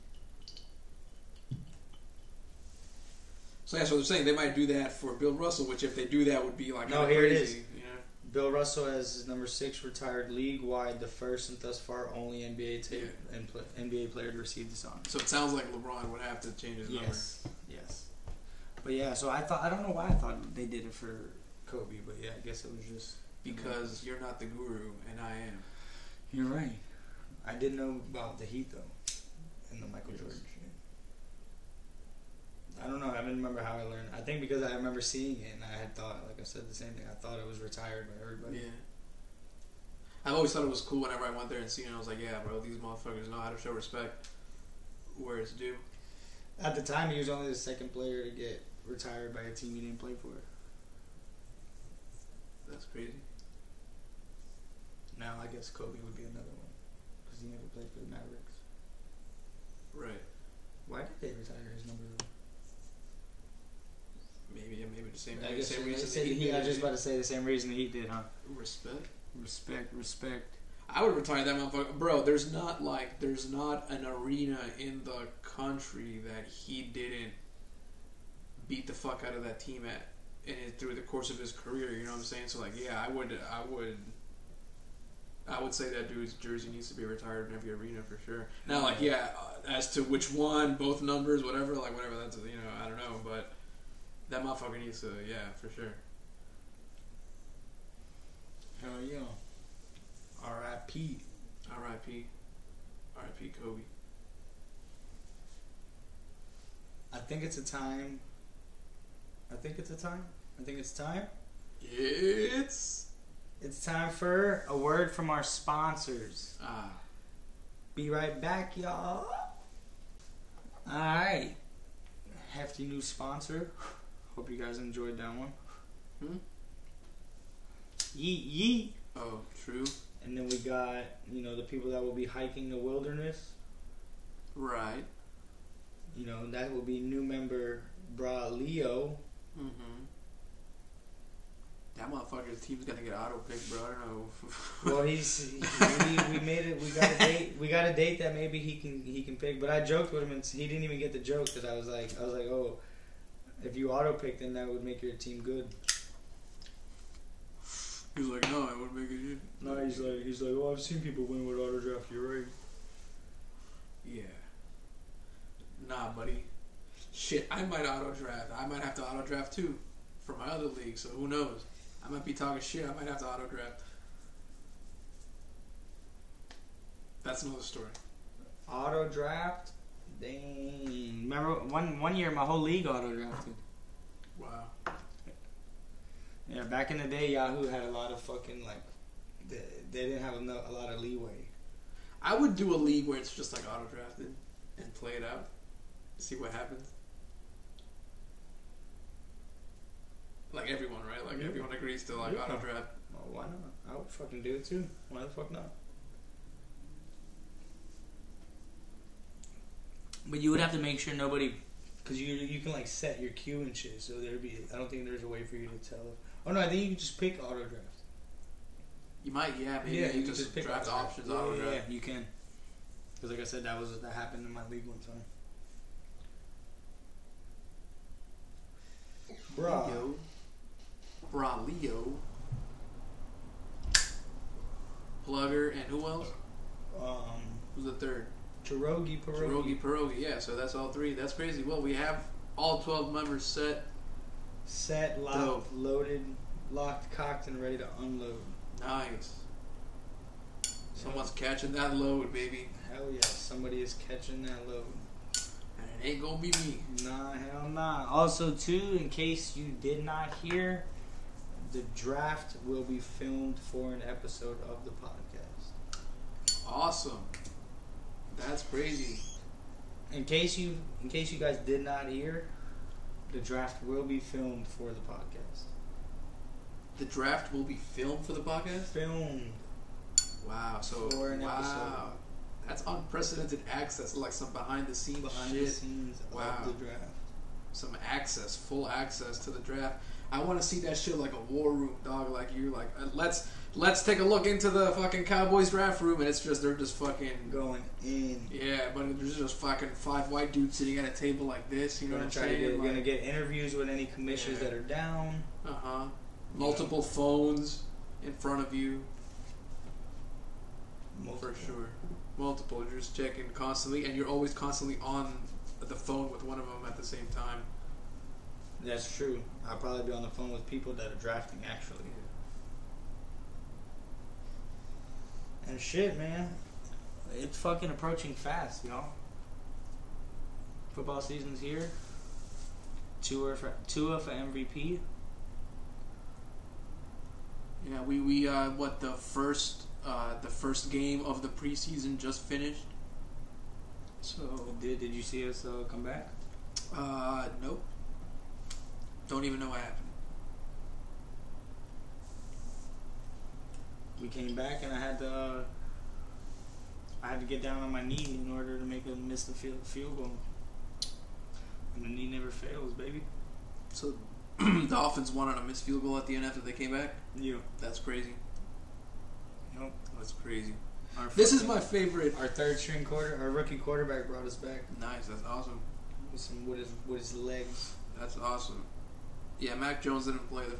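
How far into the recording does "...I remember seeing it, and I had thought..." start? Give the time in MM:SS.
00:34.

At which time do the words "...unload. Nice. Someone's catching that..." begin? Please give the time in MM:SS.
04:07.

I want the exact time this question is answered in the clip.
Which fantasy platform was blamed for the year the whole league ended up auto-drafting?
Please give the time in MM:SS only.
03:07.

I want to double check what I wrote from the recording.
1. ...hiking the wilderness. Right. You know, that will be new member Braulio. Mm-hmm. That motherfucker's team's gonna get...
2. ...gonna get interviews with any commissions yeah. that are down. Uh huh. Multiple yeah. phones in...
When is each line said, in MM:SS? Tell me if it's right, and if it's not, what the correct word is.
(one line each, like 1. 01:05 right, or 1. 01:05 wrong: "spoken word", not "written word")
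1. 02:12 right
2. 05:02 right.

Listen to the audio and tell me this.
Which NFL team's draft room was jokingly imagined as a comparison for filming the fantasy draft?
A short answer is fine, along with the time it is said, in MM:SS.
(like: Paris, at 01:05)
Cowboys, at 04:55.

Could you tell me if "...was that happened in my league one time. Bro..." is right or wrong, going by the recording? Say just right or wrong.
right.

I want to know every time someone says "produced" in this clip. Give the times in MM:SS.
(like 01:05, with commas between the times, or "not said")
not said.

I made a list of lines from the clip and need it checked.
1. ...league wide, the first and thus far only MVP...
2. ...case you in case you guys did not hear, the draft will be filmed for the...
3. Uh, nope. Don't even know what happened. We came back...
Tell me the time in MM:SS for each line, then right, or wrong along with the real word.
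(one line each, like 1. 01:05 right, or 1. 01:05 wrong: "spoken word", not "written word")
1. 00:10 wrong: "NBA", not "MVP"
2. 04:30 right
3. 05:46 right.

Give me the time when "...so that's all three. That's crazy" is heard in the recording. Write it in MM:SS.
04:00.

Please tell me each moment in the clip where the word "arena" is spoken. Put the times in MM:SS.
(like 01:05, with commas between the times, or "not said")
01:14, 01:27.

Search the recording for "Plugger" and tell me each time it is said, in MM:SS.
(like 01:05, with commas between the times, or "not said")
03:55.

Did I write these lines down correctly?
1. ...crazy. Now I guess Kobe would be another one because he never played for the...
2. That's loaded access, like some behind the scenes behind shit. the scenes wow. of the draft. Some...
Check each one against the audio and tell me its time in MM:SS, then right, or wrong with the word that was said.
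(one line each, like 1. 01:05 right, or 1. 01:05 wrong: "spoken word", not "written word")
1. 00:52 right
2. 04:42 wrong: "unprecedented", not "loaded".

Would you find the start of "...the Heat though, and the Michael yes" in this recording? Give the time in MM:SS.
00:28.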